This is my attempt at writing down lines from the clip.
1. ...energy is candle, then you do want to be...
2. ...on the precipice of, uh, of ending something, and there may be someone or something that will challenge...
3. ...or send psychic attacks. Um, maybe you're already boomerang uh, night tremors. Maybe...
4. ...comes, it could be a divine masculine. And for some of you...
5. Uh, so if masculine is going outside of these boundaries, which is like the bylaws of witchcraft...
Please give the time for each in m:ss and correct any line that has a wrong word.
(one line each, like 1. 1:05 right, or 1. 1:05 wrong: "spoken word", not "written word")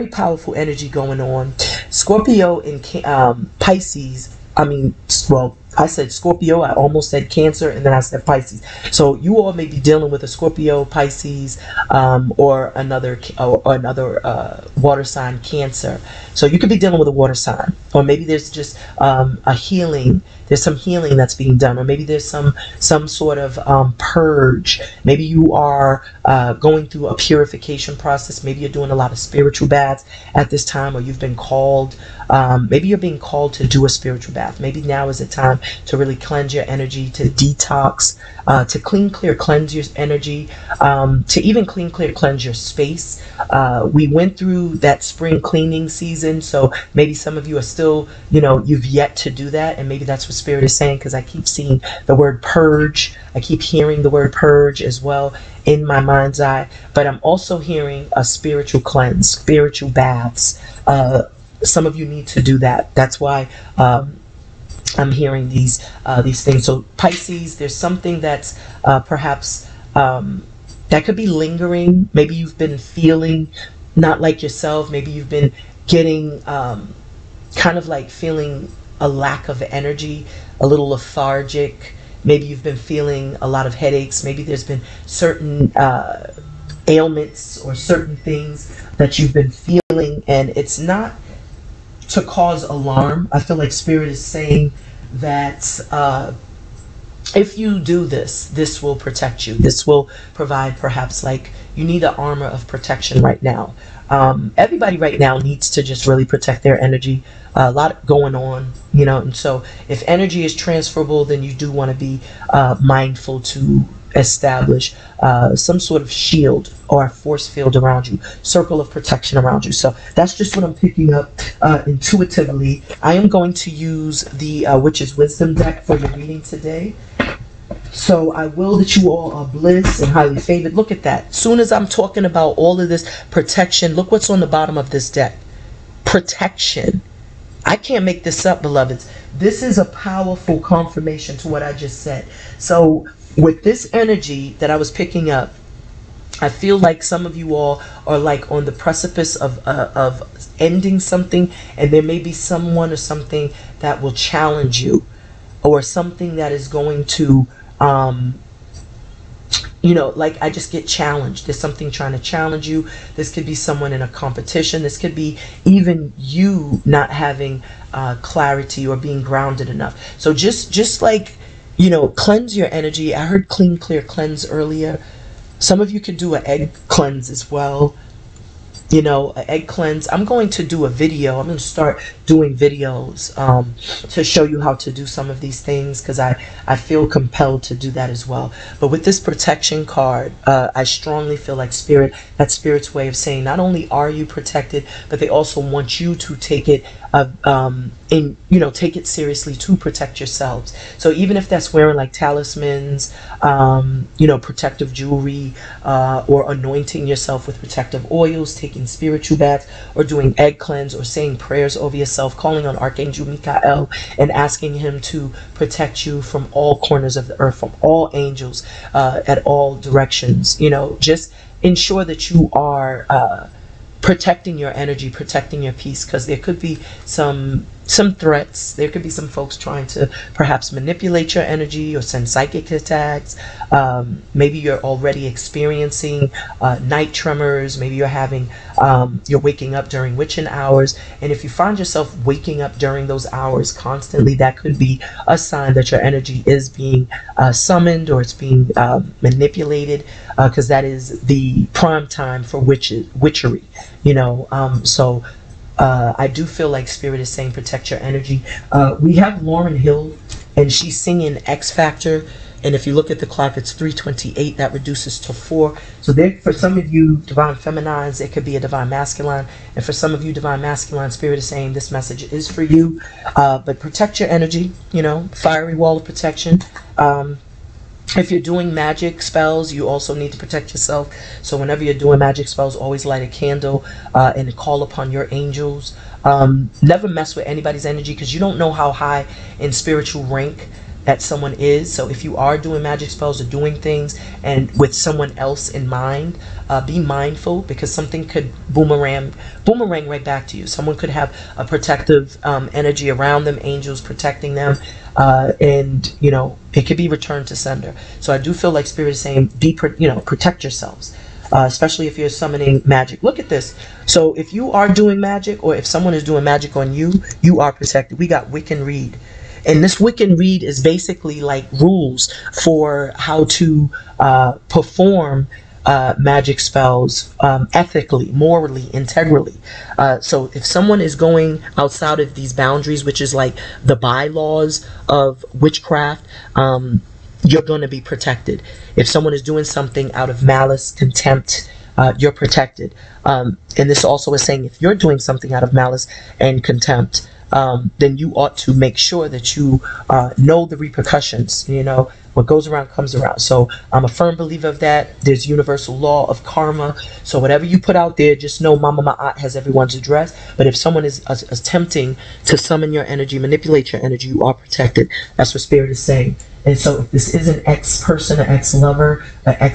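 1. 1:50 wrong: "transferable", not "candle"
2. 2:28 right
3. 3:51 wrong: "experiencing", not "boomerang"
4. 4:27 wrong: "feminines", not "comes"
5. 5:29 wrong: "someone", not "masculine".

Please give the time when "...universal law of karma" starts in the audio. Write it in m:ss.
5:55.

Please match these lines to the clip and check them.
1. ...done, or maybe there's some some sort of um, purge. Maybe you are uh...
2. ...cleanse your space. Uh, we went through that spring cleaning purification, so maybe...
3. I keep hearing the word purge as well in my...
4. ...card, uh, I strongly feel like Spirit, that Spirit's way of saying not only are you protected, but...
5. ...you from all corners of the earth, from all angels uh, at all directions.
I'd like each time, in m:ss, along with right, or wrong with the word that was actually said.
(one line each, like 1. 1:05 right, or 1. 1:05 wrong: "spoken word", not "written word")
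1. 0:21 right
2. 0:42 wrong: "season", not "purification"
3. 0:53 right
4. 3:09 right
5. 3:36 right.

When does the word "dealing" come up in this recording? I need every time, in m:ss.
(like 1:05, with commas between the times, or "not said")
0:09, 0:16.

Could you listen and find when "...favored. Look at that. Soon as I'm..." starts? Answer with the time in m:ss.
2:10.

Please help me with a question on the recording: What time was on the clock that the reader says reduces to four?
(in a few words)
3:28.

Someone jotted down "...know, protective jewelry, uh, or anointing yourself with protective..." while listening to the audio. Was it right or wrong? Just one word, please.
right.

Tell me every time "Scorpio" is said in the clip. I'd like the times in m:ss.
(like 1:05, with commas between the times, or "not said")
0:01, 0:06, 0:10.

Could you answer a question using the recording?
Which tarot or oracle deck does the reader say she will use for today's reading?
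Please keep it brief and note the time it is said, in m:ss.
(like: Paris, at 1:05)
Witch's Wisdom, at 2:04.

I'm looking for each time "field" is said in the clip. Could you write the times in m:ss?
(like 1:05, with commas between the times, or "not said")
1:57.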